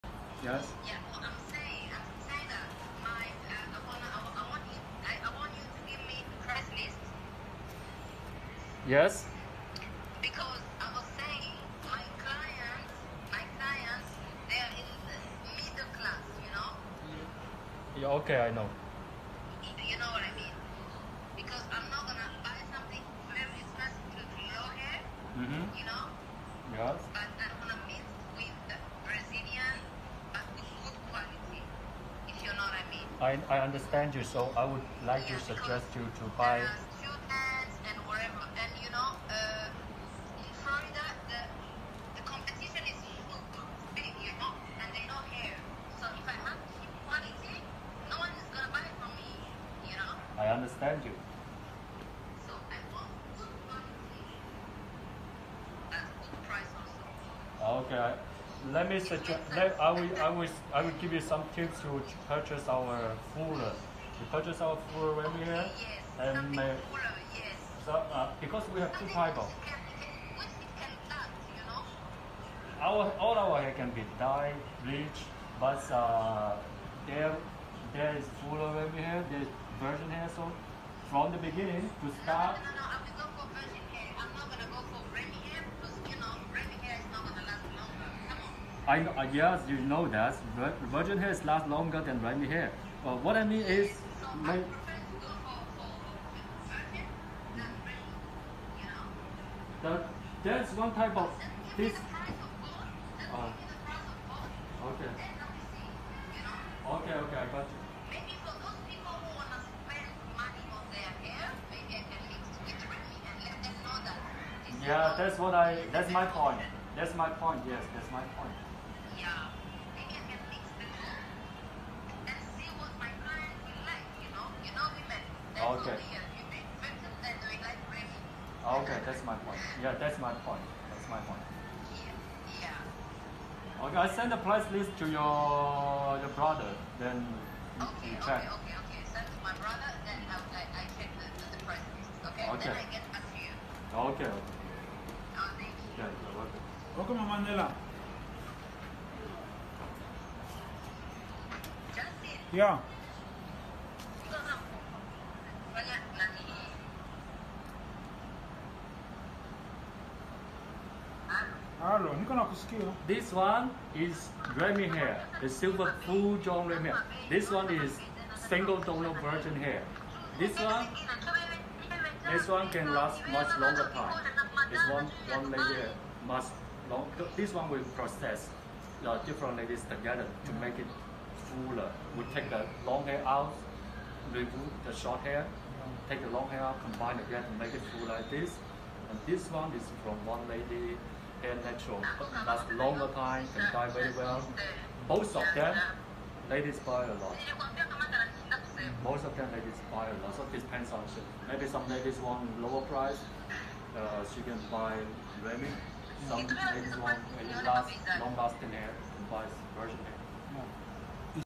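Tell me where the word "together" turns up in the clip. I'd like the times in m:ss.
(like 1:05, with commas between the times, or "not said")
2:59.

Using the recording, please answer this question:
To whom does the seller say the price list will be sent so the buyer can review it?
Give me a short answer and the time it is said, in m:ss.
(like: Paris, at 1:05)
Your brother, at 2:16.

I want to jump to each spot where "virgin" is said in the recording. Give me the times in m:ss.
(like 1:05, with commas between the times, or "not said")
1:19, 2:49, 3:29.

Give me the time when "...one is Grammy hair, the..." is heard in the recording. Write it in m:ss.
2:43.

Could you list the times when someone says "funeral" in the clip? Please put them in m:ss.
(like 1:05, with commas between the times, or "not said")
not said.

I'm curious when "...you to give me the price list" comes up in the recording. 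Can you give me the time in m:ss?
0:05.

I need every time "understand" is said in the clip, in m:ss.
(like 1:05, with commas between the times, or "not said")
0:33, 0:50.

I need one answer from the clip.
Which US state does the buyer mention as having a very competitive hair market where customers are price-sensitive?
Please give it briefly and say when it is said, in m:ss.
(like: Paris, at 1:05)
Florida, at 0:40.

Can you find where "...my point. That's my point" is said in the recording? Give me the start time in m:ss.
2:10.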